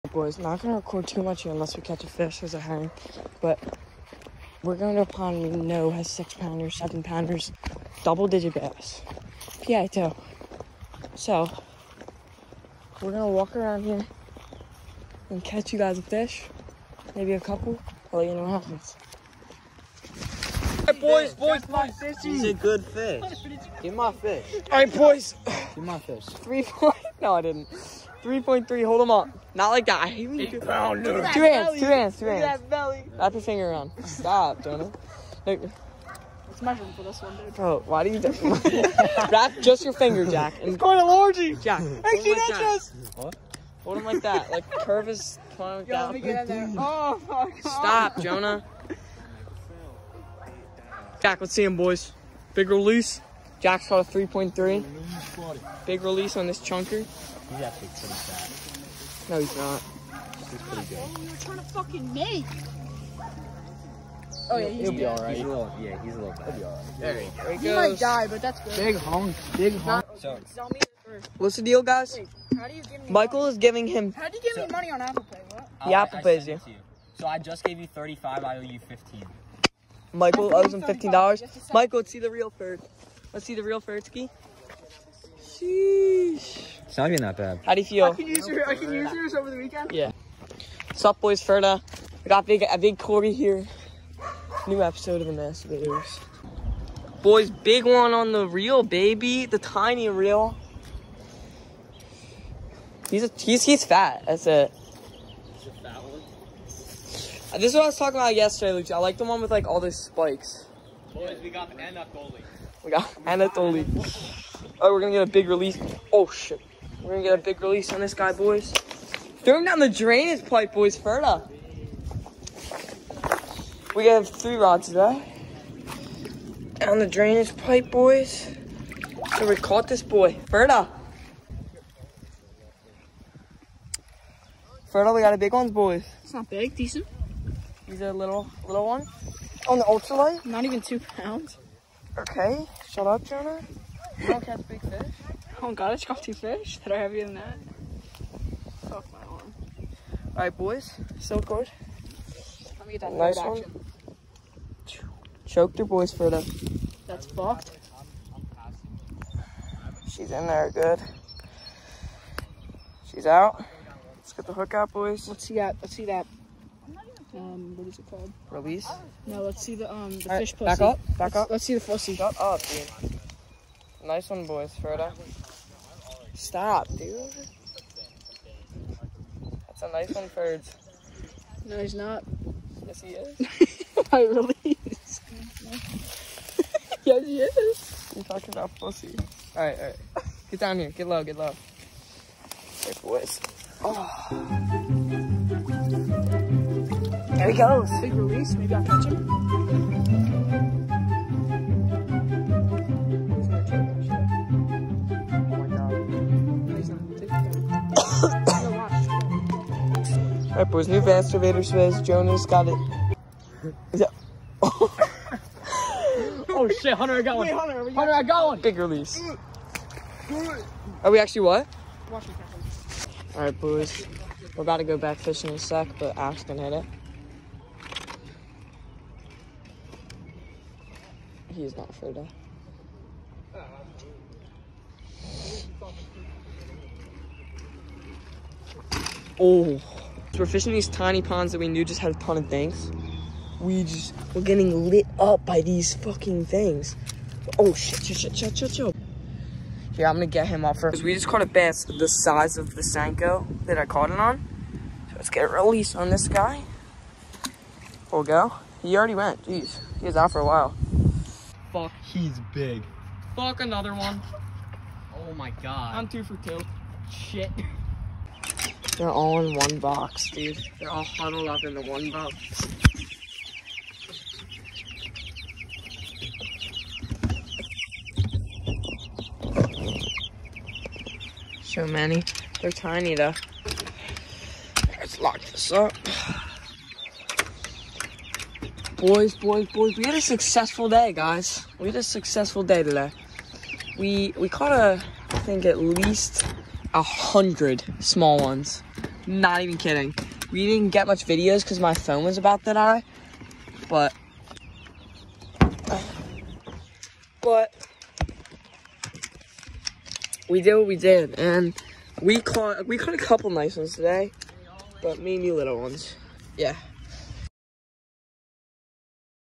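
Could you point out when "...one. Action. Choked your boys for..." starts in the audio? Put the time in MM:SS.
02:33.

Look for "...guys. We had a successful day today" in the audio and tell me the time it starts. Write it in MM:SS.
04:51.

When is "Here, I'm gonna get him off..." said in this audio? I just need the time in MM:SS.
04:09.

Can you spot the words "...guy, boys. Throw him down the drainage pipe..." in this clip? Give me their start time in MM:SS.
01:58.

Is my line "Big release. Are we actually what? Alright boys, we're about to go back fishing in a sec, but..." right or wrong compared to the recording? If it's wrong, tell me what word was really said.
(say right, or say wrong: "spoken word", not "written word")
right.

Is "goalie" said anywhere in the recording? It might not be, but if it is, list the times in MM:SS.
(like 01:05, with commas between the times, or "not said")
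01:52.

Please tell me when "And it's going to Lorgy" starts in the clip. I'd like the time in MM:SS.
00:40.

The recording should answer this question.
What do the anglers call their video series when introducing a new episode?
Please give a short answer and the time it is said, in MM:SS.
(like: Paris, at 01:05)
Master Baiters, at 01:35.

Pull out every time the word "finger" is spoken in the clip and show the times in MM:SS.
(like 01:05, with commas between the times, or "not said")
00:33, 00:39.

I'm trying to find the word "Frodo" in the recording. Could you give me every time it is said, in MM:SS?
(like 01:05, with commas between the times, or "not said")
02:54, 03:51.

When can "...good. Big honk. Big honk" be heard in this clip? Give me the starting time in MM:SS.
01:08.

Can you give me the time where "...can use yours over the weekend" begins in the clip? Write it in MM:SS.
01:28.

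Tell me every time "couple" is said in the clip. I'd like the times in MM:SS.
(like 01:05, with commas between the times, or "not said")
00:17, 05:13.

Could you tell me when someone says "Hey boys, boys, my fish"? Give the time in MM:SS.
00:20.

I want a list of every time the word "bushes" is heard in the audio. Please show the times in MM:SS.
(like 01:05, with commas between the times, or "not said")
not said.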